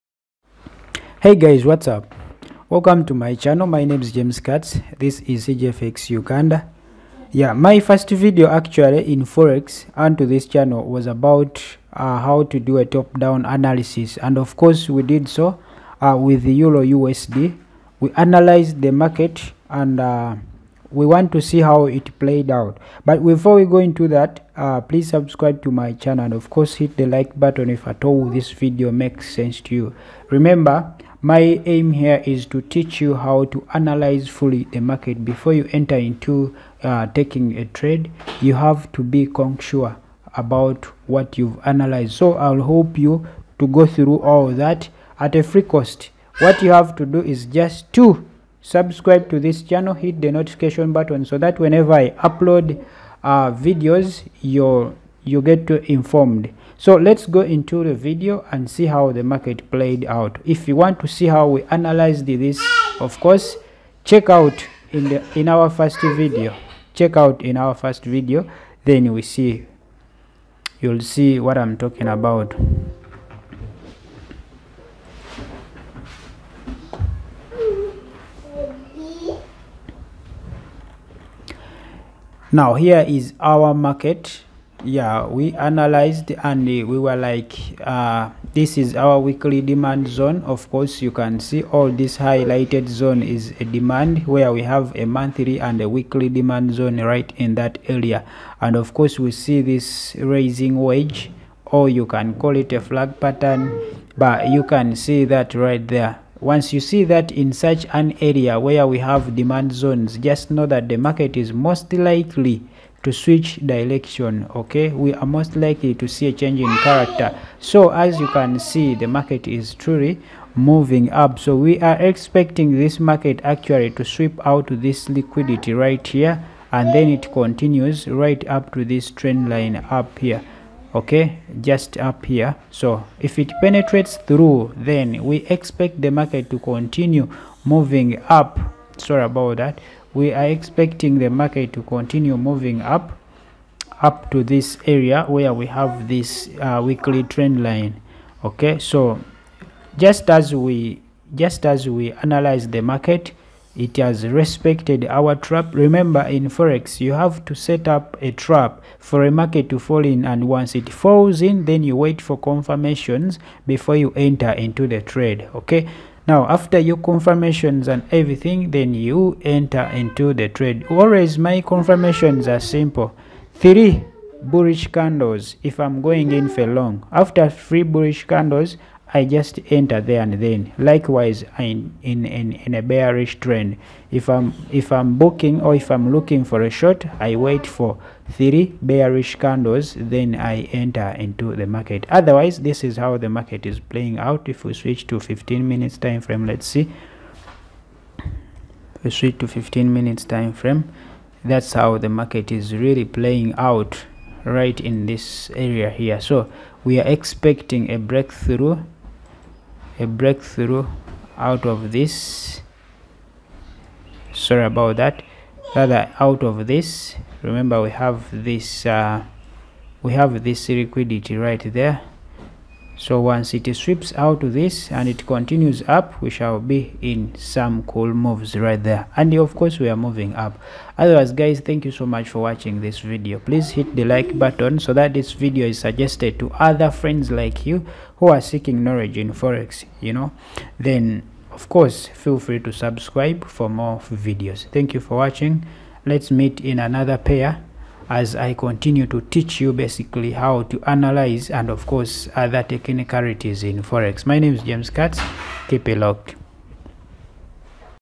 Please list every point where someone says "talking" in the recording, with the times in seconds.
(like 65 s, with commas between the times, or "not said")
71 s.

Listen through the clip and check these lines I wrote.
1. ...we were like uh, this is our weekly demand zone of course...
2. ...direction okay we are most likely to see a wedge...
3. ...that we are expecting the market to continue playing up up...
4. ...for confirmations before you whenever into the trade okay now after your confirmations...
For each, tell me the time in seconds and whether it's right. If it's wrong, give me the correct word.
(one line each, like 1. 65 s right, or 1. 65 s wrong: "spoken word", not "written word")
1. 86 s right
2. 113 s wrong: "change", not "wedge"
3. 139 s wrong: "moving", not "playing"
4. 162 s wrong: "enter", not "whenever".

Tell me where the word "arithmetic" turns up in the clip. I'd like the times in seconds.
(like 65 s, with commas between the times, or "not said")
not said.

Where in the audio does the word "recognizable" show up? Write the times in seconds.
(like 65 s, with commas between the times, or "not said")
not said.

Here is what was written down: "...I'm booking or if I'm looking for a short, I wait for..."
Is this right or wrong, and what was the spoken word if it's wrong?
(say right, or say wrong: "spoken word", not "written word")
right.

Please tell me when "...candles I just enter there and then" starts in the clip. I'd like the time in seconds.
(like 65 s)
178 s.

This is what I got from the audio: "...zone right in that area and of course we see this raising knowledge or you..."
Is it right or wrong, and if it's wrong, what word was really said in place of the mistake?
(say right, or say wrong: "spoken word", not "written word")
wrong: "wedge", not "knowledge".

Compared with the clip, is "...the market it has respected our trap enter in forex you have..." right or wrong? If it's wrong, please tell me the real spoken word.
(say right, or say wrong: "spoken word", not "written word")
wrong: "remember", not "enter".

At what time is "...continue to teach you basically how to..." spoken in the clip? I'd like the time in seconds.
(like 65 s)
248 s.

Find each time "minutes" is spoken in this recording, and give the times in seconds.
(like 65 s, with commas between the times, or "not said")
195 s, 199 s.